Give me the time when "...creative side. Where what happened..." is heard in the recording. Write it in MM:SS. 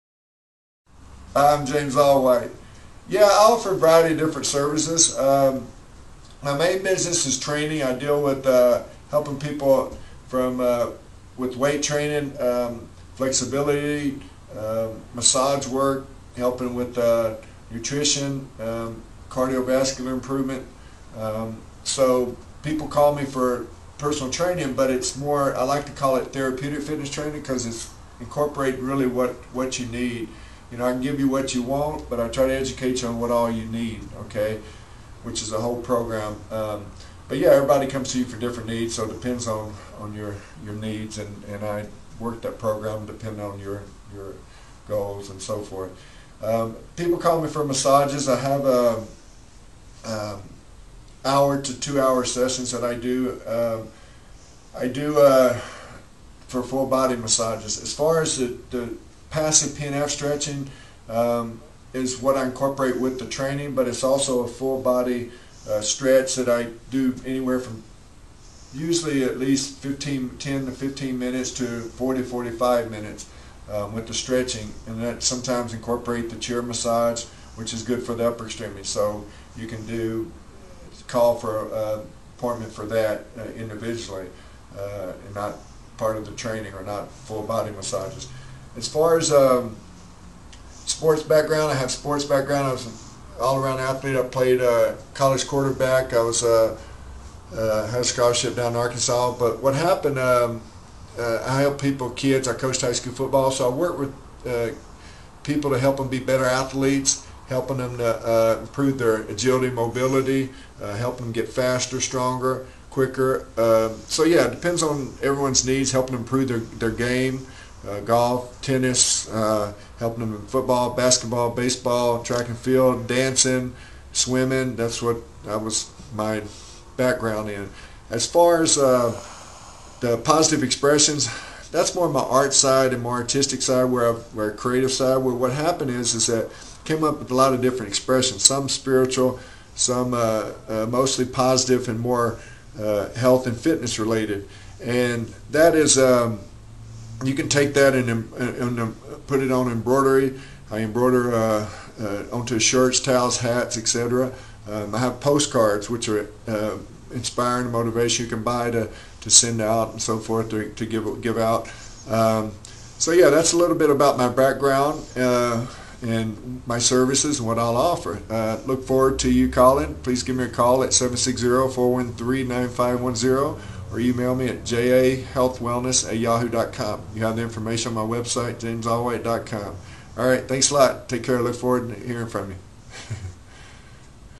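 02:14.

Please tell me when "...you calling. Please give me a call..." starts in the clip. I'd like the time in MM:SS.
02:49.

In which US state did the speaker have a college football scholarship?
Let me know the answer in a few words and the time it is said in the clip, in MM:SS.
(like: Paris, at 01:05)
Arkansas, at 01:38.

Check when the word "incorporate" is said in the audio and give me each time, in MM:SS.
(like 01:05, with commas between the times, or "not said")
00:28, 01:02, 01:15.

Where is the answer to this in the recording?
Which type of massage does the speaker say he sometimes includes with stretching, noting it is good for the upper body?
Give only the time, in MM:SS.
01:16.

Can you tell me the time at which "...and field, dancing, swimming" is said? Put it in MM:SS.
02:02.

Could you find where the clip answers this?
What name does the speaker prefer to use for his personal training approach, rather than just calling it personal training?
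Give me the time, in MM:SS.
00:26.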